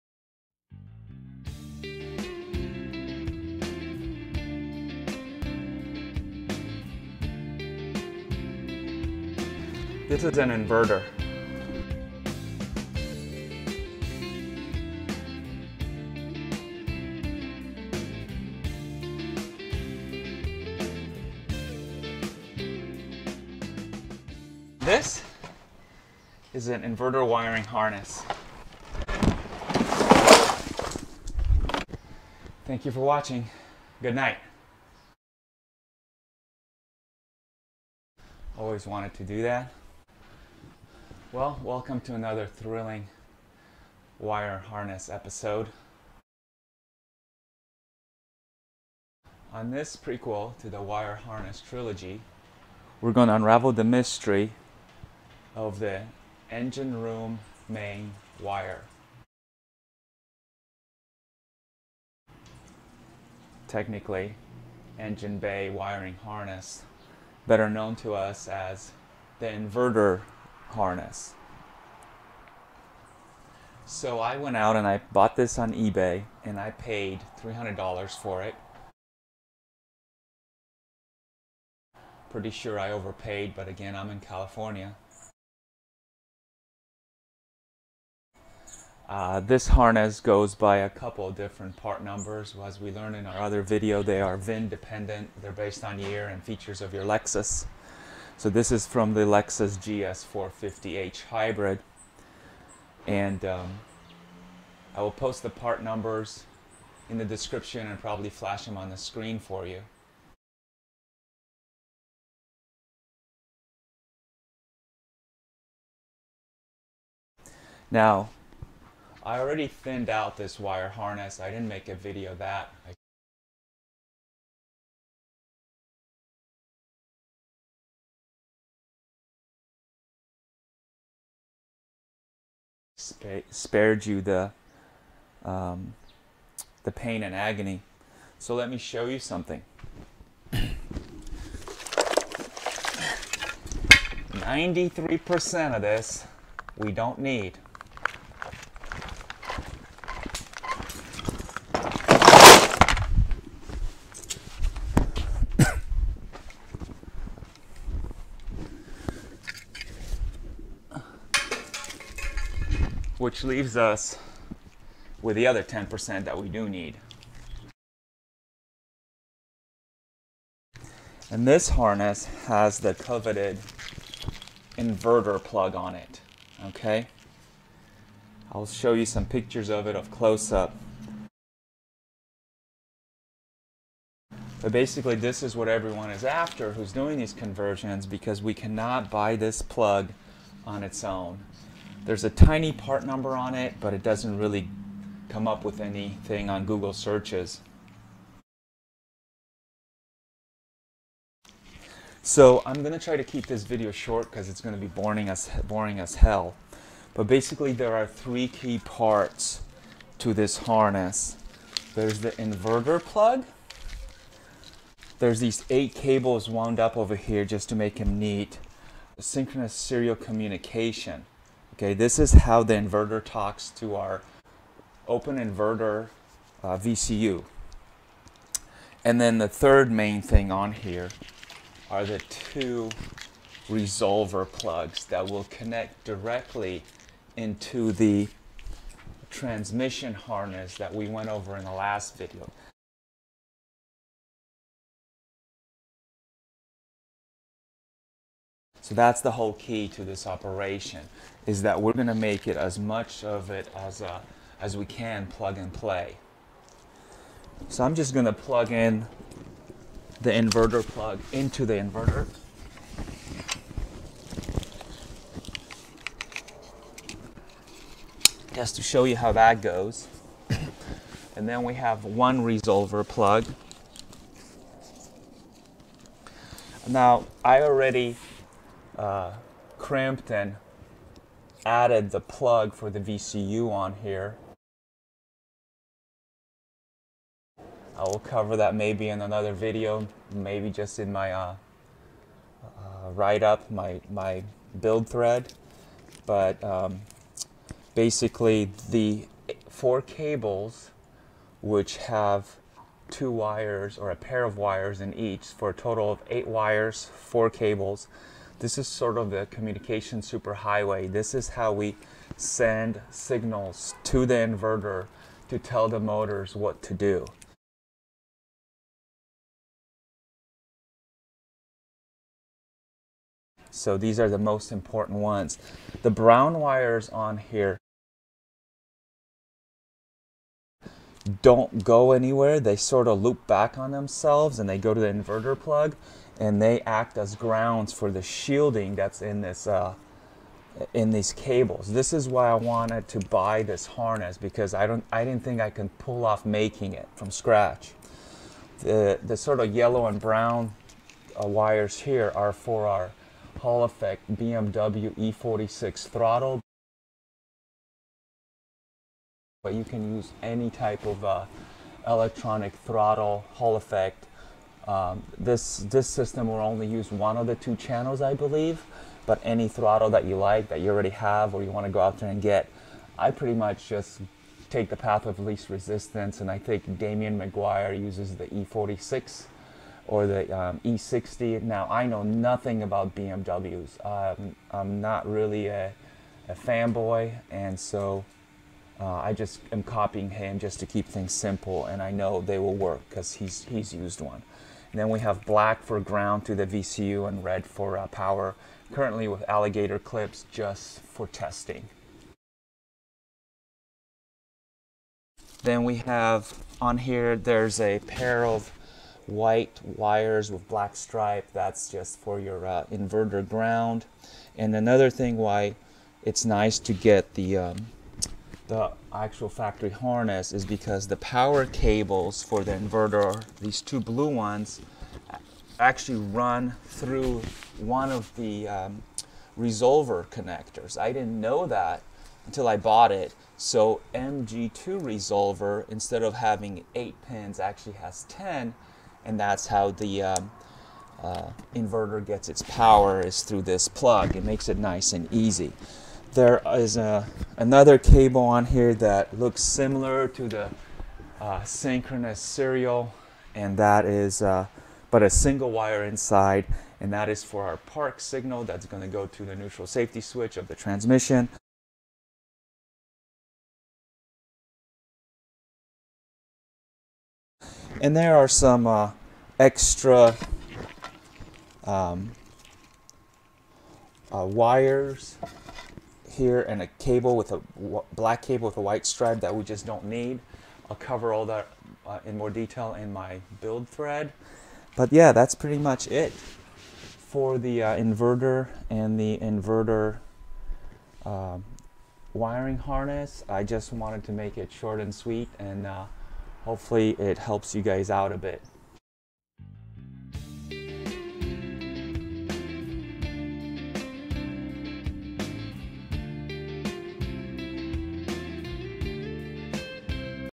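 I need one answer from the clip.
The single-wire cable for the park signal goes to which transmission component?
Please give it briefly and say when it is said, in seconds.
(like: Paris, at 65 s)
neutral safety switch, at 459 s.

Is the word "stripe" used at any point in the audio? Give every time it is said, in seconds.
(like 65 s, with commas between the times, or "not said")
410 s, 479 s.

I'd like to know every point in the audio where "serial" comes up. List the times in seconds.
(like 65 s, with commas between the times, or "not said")
219 s, 452 s.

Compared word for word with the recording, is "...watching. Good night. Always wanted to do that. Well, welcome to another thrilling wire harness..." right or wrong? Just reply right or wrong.
right.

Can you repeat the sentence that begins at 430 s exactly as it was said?
I didn't know that until I bought it.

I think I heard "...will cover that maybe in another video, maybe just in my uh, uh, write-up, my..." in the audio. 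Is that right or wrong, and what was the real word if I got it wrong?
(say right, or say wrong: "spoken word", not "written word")
right.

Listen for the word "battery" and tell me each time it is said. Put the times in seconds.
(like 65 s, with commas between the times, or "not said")
not said.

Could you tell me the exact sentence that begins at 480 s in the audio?
I'll cover all that uh, in more detail in my build thread.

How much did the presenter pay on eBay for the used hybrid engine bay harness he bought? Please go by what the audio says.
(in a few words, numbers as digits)
$300.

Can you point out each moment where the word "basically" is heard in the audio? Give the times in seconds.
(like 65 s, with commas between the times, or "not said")
184 s, 207 s, 297 s.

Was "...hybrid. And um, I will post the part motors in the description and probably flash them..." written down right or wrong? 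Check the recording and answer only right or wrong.
wrong.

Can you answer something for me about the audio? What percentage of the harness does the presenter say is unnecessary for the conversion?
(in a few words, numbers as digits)
93%.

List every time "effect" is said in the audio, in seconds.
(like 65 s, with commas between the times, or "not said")
353 s, 363 s.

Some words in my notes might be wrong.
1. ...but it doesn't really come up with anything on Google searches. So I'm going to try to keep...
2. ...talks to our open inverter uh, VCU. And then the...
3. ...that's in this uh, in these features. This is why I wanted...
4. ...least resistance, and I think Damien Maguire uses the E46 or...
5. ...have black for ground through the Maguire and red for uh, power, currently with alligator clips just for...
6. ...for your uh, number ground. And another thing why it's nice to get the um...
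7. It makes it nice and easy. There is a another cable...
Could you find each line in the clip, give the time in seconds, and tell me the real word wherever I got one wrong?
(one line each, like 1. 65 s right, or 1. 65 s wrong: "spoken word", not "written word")
1. 193 s right
2. 223 s right
3. 338 s wrong: "cables", not "features"
4. 375 s right
5. 395 s wrong: "VCU", not "Maguire"
6. 412 s wrong: "inverter", not "number"
7. 444 s right.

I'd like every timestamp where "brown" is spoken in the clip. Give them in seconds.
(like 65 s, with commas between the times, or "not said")
326 s, 350 s.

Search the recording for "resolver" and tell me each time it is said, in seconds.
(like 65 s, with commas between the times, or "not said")
233 s, 272 s, 429 s, 435 s.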